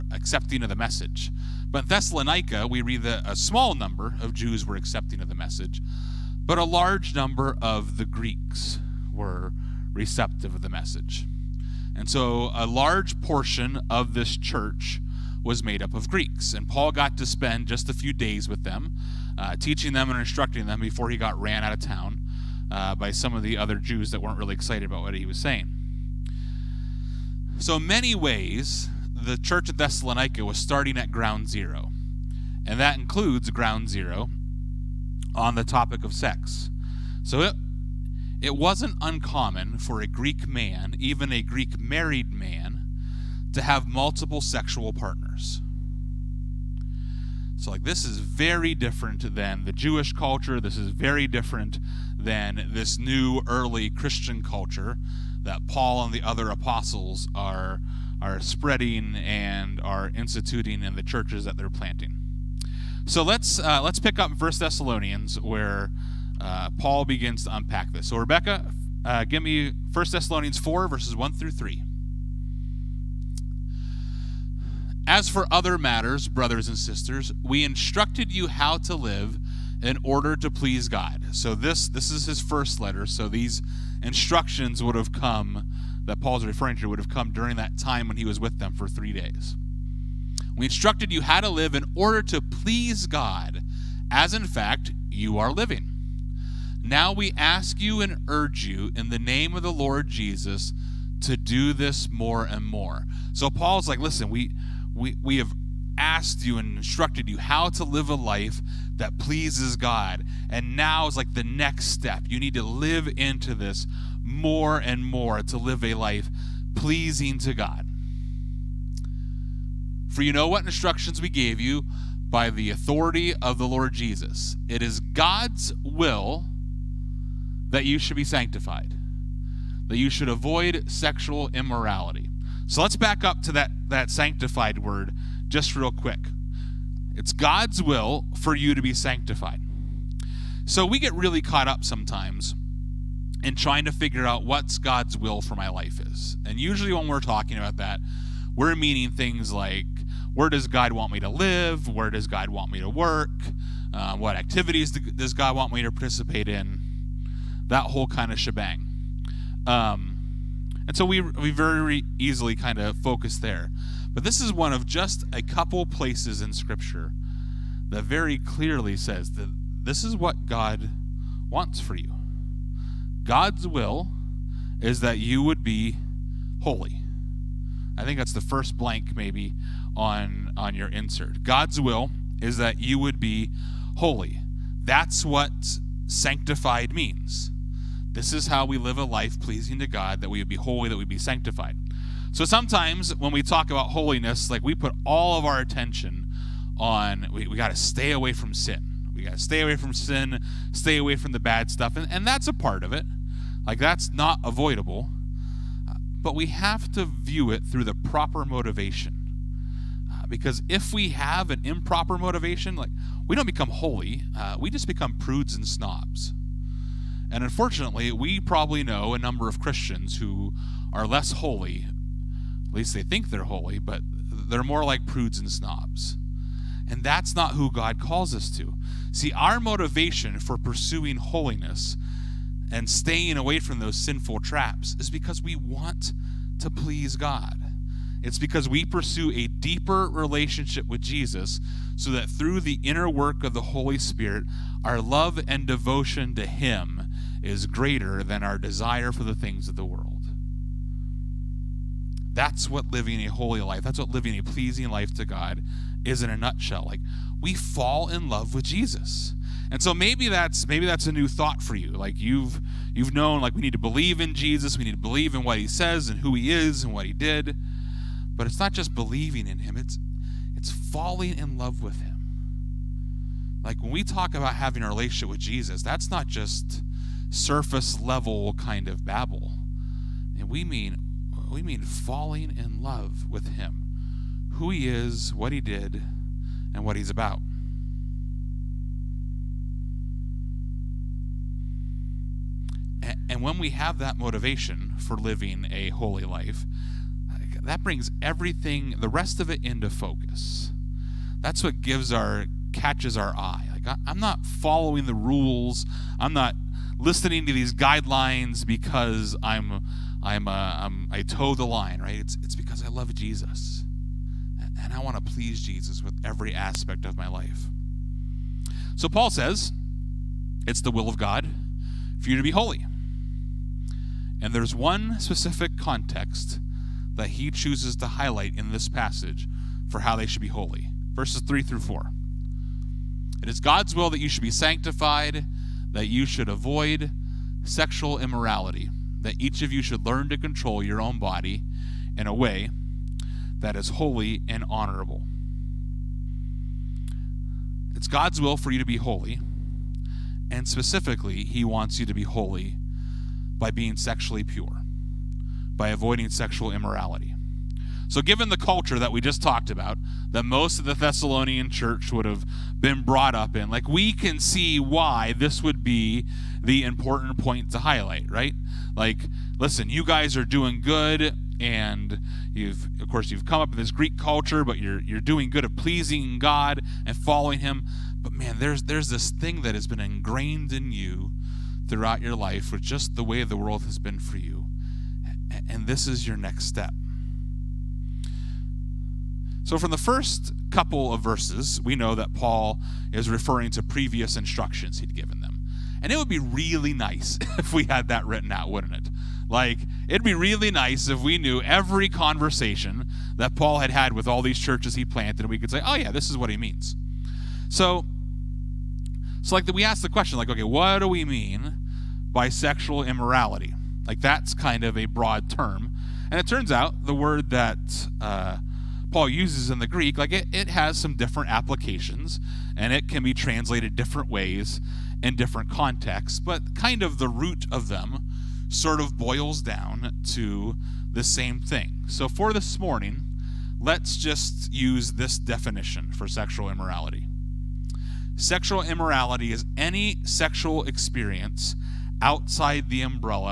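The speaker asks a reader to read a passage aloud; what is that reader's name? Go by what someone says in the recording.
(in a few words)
Rebecca.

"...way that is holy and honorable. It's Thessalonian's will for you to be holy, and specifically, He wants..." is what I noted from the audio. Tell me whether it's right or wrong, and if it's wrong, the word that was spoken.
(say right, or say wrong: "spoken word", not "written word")
wrong: "God", not "Thessalonian".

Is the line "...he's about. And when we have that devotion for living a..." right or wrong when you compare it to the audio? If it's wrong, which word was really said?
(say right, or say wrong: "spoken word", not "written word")
wrong: "motivation", not "devotion".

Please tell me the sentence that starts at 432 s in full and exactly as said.
So for this morning, let's just use this definition for sexual immorality.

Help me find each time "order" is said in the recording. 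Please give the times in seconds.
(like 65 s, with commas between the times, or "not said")
80 s, 91 s.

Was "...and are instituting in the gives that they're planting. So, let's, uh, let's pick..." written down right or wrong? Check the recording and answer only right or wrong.
wrong.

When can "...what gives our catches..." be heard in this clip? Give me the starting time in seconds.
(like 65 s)
301 s.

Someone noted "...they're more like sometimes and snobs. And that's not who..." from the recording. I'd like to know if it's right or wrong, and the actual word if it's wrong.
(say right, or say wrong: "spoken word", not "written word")
wrong: "prudes", not "sometimes".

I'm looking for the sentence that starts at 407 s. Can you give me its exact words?
So, so like, we asked the question, like, okay, what do we mean by sexual immorality?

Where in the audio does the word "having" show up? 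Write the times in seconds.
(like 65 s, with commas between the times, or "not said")
274 s.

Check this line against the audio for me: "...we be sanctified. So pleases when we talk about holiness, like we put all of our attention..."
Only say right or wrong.
wrong.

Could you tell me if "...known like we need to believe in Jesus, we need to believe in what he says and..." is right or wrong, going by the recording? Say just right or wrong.
right.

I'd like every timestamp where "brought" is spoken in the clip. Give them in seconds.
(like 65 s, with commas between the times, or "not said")
363 s.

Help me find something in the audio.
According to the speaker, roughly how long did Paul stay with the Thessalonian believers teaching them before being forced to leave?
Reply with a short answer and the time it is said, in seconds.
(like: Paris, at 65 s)
3 days, at 88 s.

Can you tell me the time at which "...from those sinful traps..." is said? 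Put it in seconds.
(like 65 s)
233 s.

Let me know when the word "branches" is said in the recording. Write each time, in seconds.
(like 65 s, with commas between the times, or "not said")
not said.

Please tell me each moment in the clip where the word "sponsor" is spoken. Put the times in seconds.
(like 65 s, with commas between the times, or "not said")
not said.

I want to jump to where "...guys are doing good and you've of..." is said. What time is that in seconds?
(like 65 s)
370 s.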